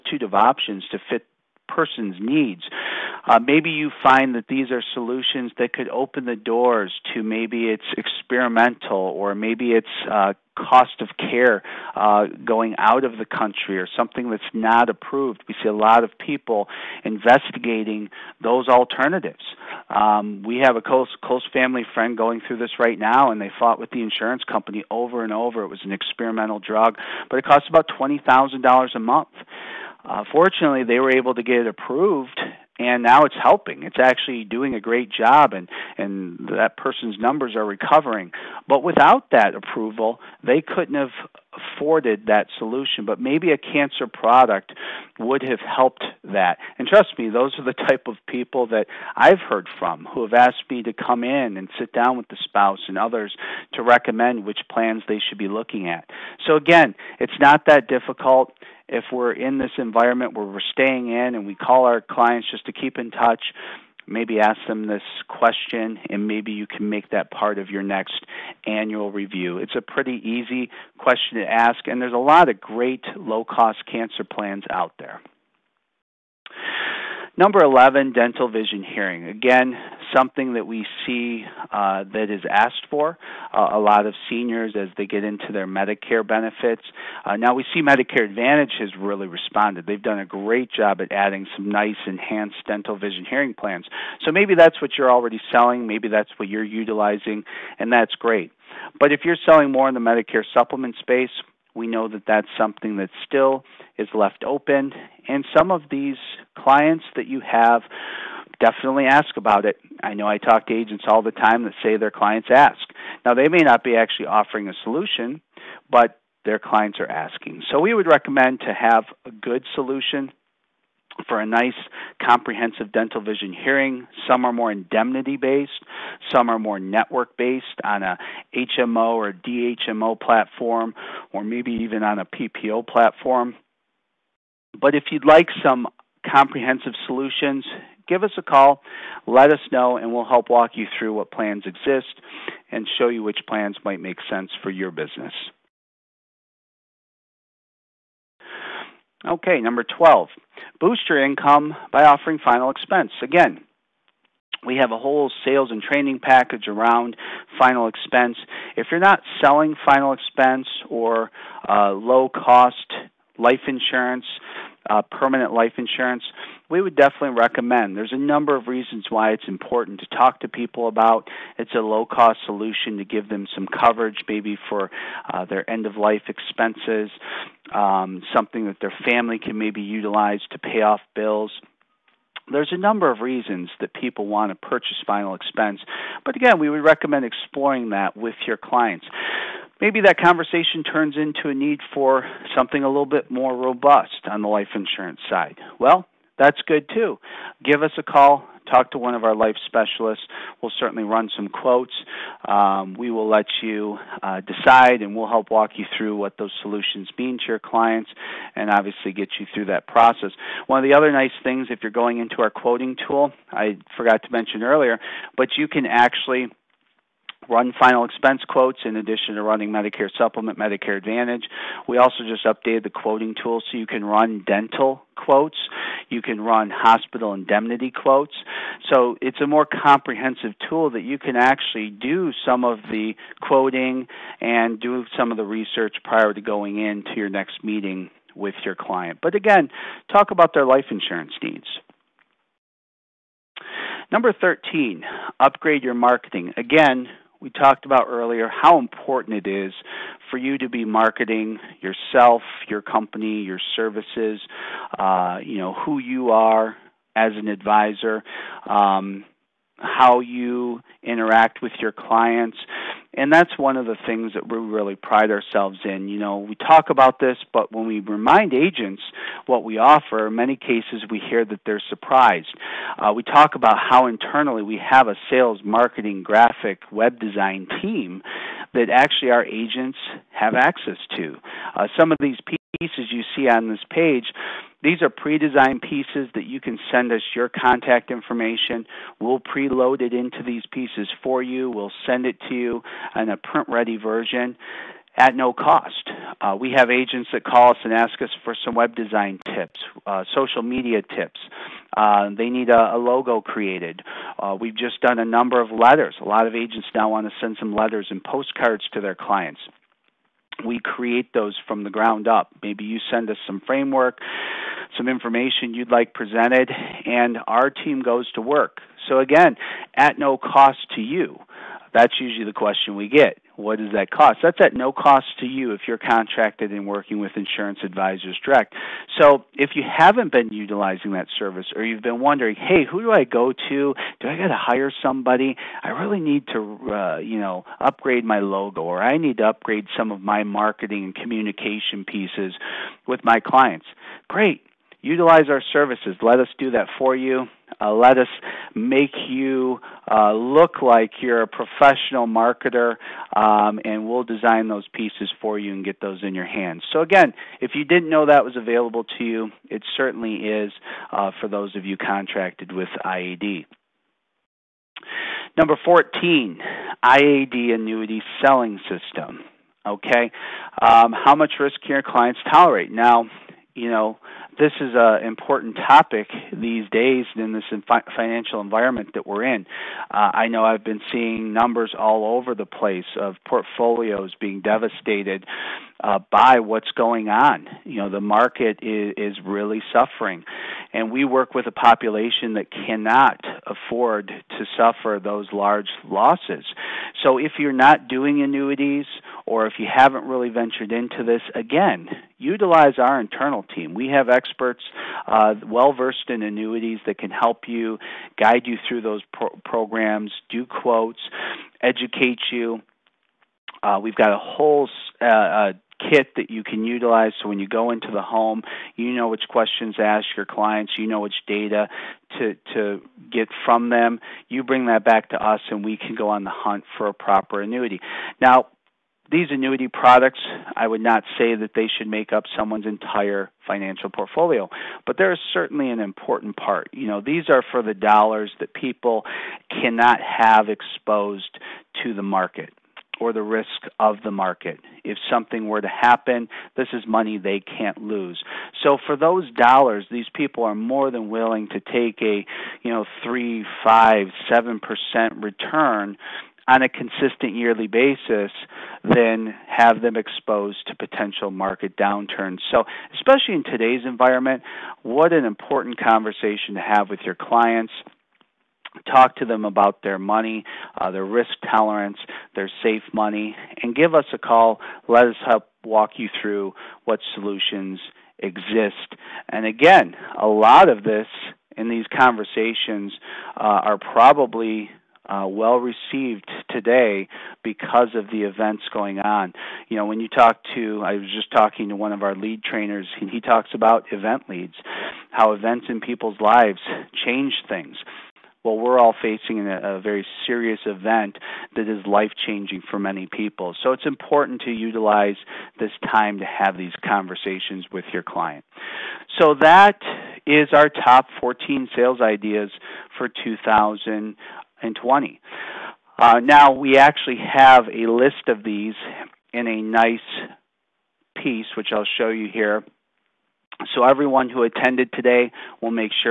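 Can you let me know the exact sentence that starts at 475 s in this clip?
Let us help walk you through what solutions exist.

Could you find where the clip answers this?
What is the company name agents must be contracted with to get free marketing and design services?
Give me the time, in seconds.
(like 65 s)
327 s.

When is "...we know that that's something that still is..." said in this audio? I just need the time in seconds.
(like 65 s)
101 s.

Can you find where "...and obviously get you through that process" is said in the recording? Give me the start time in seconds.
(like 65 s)
208 s.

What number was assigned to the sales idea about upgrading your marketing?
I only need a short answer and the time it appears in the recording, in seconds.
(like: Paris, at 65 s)
13, at 244 s.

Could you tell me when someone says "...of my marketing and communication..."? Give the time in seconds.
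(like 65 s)
340 s.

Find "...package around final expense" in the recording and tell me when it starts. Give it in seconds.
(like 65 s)
156 s.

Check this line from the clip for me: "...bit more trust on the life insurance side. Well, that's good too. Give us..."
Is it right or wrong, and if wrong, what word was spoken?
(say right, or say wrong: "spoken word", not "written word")
wrong: "robust", not "trust".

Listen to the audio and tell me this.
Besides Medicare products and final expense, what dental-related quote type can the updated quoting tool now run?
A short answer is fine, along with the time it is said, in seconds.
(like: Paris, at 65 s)
dental quotes, at 224 s.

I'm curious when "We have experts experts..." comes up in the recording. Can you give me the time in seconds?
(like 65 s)
403 s.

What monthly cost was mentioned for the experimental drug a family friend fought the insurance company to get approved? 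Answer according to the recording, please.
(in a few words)
$20,000.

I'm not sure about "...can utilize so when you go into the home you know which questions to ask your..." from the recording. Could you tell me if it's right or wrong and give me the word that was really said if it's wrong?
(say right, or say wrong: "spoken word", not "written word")
right.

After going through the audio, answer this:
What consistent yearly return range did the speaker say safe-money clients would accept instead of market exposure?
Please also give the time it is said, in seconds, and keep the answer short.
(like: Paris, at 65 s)
3, 5, 7 percent, at 453 s.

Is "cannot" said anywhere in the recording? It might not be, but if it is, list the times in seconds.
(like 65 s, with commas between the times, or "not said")
392 s, 439 s.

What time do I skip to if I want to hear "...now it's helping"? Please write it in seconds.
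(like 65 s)
33 s.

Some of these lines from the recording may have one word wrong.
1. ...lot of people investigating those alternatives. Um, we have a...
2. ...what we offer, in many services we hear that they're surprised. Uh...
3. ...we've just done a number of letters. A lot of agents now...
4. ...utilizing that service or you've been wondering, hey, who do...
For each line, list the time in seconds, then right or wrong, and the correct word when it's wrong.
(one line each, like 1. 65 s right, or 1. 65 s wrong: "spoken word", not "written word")
1. 15 s right
2. 269 s wrong: "cases", not "services"
3. 304 s right
4. 330 s right.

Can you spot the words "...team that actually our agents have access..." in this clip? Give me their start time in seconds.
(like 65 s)
277 s.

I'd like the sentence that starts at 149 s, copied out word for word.
Okay, number 12, boost your income by offering final expense.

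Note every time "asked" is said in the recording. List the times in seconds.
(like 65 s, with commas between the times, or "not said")
50 s, 82 s.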